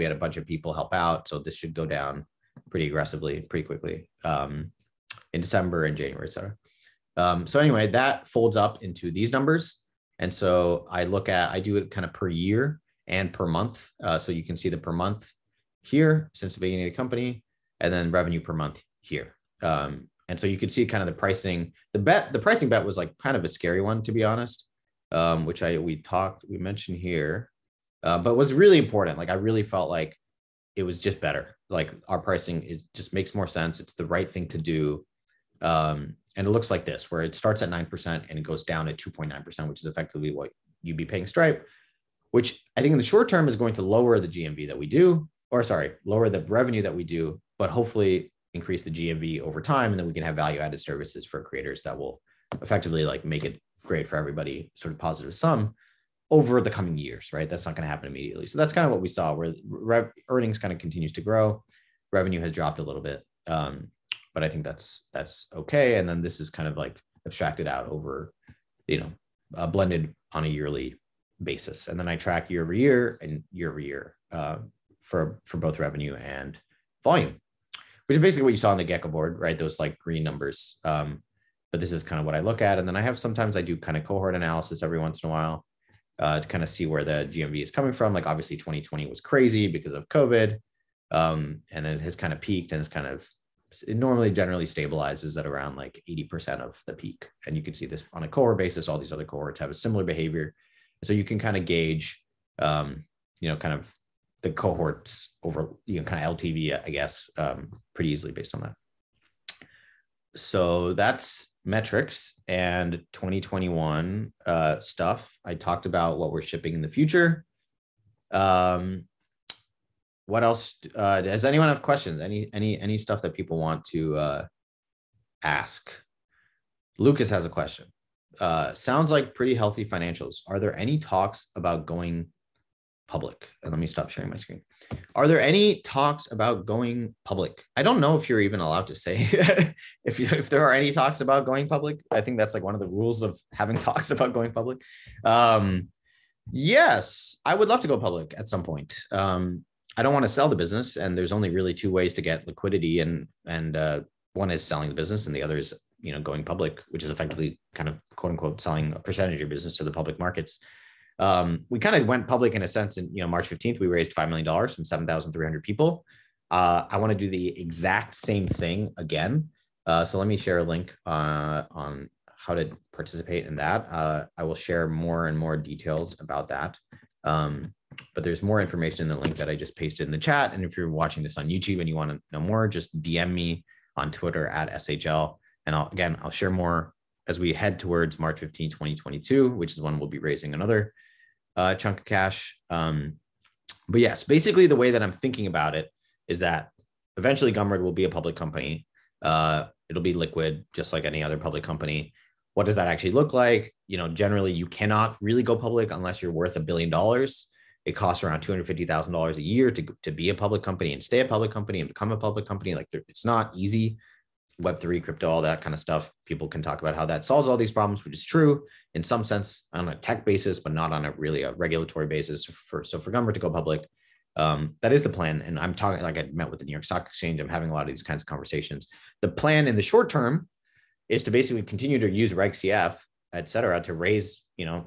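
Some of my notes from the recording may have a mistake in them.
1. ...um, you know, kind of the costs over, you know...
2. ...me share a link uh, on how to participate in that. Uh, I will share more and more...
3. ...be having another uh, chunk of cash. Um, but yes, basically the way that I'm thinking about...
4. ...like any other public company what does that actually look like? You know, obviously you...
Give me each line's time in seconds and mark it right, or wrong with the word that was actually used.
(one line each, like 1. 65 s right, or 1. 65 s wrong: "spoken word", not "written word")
1. 102 s wrong: "cohorts", not "costs"
2. 170 s right
3. 190 s wrong: "raising", not "having"
4. 200 s wrong: "generally", not "obviously".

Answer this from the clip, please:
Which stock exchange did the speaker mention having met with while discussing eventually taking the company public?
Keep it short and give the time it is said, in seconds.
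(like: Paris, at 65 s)
New York Stock Exchange, at 226 s.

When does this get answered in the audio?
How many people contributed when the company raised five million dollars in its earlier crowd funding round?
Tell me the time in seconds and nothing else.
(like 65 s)
164 s.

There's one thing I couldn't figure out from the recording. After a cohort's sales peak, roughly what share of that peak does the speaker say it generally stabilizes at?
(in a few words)
80%.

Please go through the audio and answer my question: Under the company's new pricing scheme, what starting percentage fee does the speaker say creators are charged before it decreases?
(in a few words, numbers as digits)
9%.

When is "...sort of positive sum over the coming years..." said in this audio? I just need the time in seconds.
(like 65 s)
54 s.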